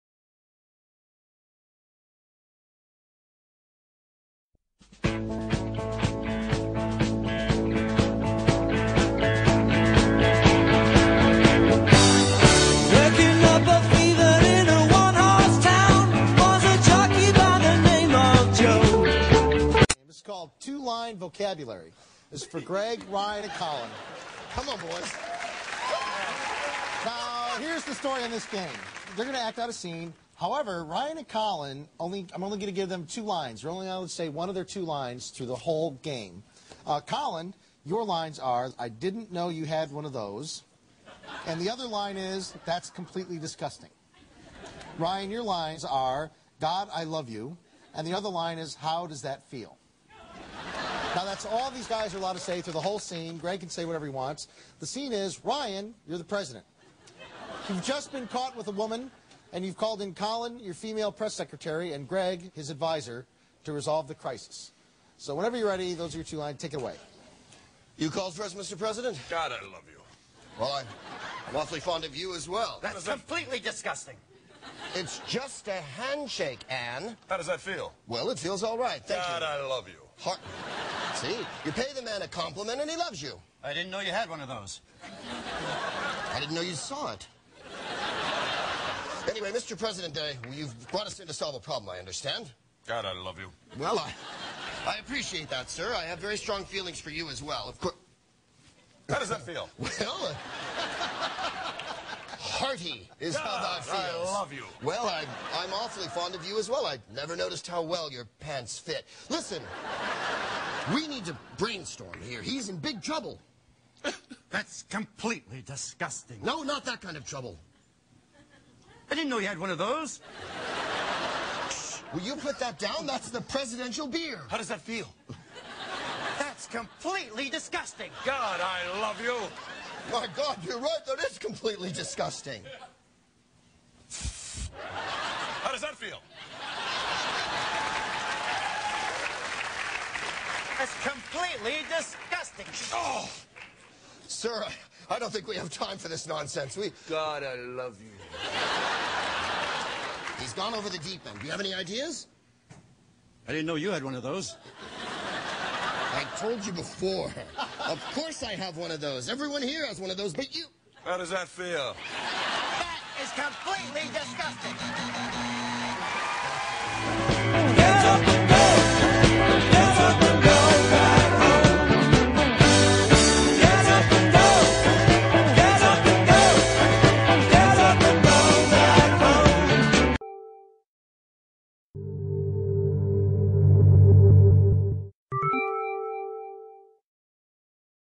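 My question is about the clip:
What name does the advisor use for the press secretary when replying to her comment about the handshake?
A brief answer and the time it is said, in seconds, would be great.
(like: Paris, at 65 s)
Anne, at 76 s.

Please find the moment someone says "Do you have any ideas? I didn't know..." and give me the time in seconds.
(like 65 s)
151 s.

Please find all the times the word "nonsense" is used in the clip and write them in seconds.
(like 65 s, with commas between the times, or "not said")
146 s.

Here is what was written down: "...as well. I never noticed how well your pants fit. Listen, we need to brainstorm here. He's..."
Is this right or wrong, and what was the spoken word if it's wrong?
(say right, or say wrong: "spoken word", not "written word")
right.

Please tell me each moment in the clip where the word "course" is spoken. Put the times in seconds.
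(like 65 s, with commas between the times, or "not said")
97 s, 158 s.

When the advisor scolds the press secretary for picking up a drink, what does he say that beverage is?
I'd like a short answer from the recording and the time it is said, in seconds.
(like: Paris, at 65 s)
The presidential beer, at 123 s.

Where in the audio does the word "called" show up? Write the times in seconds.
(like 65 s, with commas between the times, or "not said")
59 s, 68 s.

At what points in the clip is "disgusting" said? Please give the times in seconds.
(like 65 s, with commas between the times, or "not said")
43 s, 73 s, 115 s, 127 s, 131 s, 141 s, 164 s.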